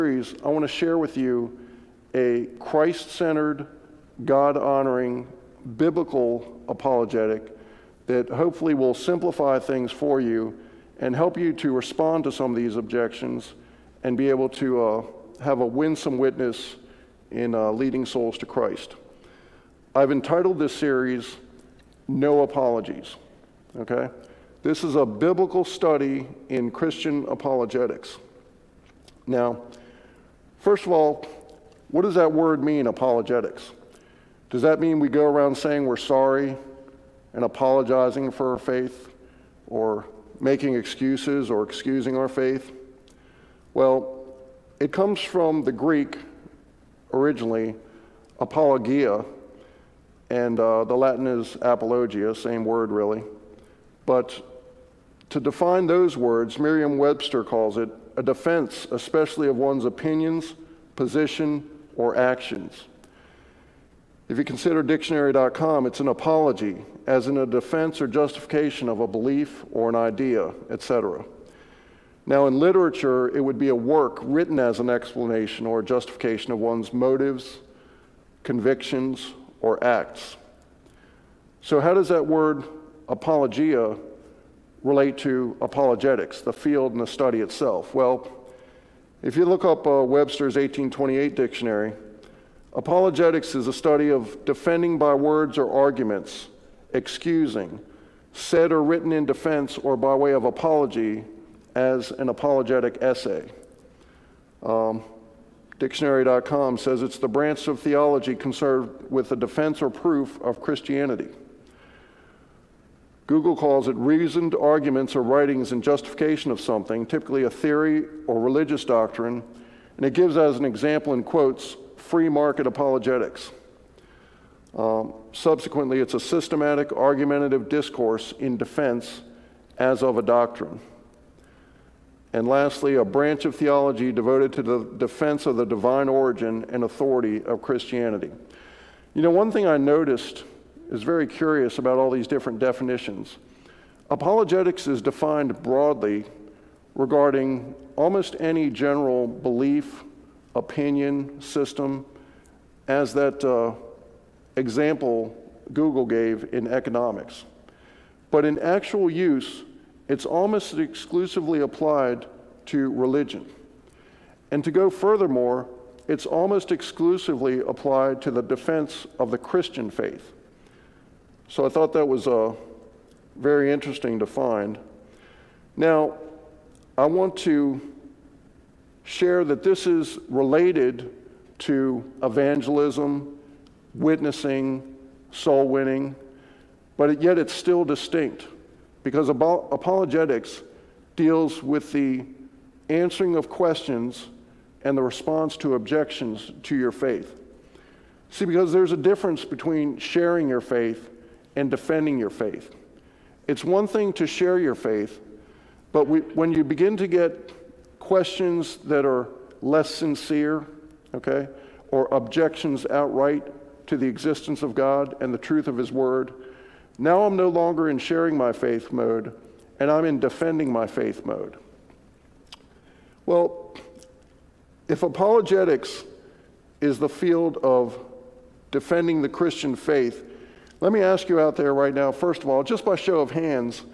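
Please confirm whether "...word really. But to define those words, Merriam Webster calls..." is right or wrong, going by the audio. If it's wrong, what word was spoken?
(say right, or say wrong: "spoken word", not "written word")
right.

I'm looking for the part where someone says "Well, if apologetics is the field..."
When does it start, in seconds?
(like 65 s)
223 s.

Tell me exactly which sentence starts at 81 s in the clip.
So, how does that word apologia relate to apologetics, the field and the study itself?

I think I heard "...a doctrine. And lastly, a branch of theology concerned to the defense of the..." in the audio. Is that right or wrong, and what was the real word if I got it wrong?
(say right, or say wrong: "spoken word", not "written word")
wrong: "devoted", not "concerned".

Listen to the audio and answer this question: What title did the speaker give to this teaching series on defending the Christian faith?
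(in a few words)
No Apologies.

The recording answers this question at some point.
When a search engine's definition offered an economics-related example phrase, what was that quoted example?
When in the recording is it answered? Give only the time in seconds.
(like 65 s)
121 s.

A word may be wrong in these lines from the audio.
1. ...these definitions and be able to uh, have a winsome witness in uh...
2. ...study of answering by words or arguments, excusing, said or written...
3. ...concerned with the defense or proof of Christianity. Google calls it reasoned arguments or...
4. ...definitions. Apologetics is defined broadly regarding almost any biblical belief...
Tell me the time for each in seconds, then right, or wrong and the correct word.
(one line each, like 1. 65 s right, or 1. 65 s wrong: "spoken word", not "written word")
1. 12 s wrong: "objections", not "definitions"
2. 93 s wrong: "defending", not "answering"
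3. 108 s right
4. 142 s wrong: "general", not "biblical".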